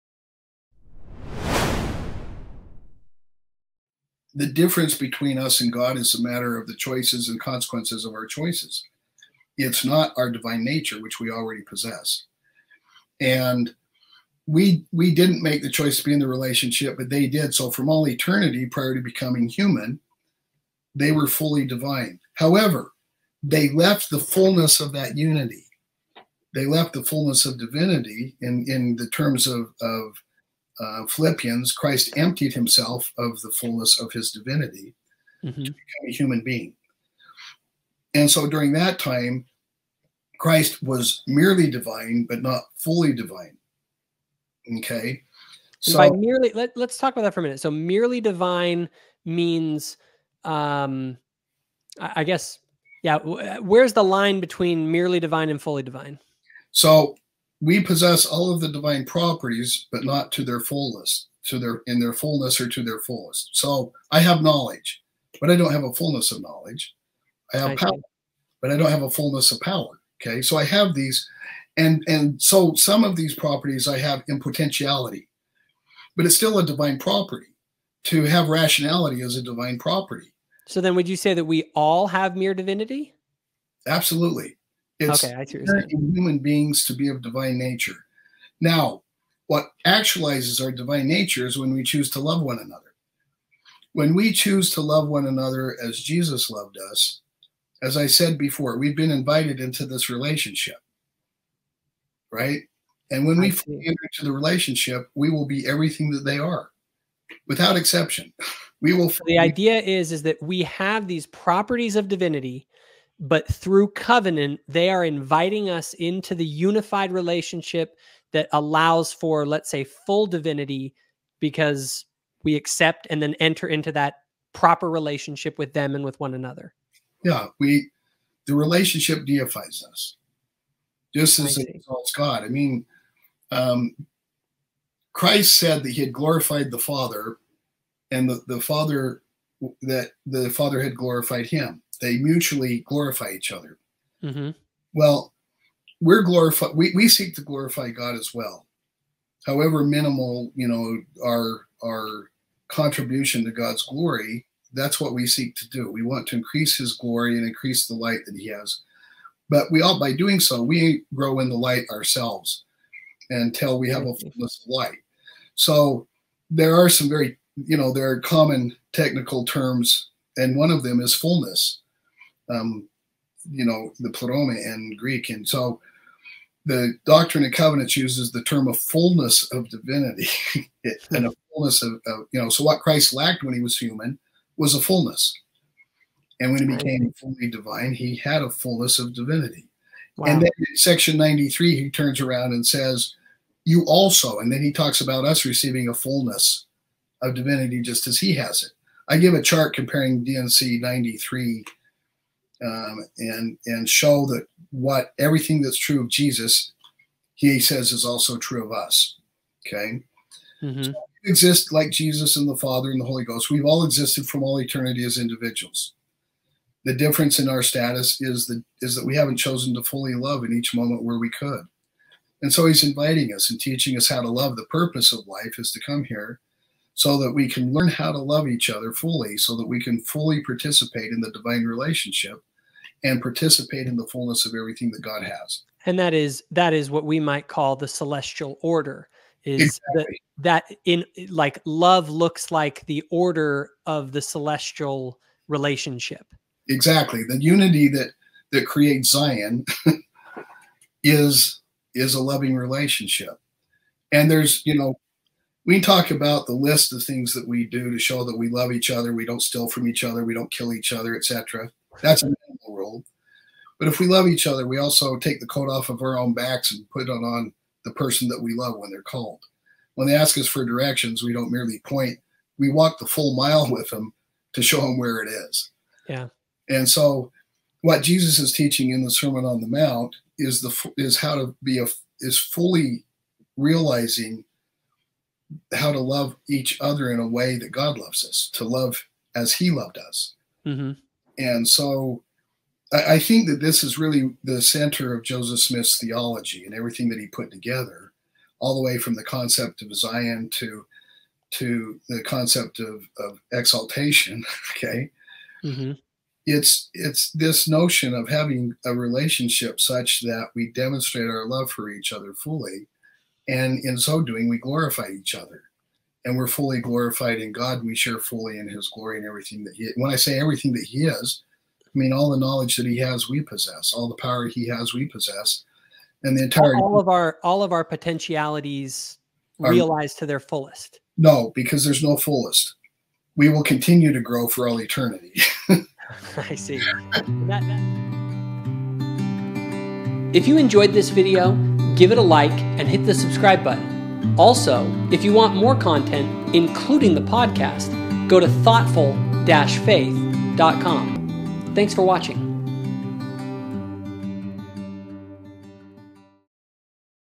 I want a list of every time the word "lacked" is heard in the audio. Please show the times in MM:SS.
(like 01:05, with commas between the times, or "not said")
03:03.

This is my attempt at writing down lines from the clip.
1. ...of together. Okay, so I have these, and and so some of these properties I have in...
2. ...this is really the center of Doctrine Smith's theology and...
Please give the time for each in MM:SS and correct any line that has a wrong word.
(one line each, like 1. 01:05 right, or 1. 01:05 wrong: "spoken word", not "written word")
1. 01:09 wrong: "power", not "together"
2. 04:53 wrong: "Joseph", not "Doctrine".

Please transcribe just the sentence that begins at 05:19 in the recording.
When I say everything that He is, I mean, all the knowledge that he has, we possess.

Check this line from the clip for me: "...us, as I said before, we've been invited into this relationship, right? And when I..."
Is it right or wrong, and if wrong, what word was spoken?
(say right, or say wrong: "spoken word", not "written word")
right.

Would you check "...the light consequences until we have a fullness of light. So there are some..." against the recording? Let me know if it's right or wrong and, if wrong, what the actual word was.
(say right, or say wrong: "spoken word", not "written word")
wrong: "ourselves", not "consequences".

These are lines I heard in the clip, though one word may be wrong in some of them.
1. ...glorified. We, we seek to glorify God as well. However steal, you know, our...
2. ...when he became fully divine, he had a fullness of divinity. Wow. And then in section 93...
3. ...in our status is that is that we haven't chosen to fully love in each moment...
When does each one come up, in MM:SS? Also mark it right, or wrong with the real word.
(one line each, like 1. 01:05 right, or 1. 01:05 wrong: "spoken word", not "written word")
1. 02:26 wrong: "minimal", not "steal"
2. 03:06 right
3. 03:37 right.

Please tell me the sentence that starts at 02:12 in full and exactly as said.
I mean, um, Christ said that he had glorified the Father, and the, the Father that the Father had glorified him.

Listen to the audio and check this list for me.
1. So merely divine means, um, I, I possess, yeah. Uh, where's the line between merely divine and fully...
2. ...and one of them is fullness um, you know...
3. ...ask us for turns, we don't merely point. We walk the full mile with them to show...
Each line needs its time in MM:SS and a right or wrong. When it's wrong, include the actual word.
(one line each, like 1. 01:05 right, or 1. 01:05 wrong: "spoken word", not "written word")
1. 00:47 wrong: "guess", not "possess"
2. 02:50 right
3. 04:30 wrong: "directions", not "turns".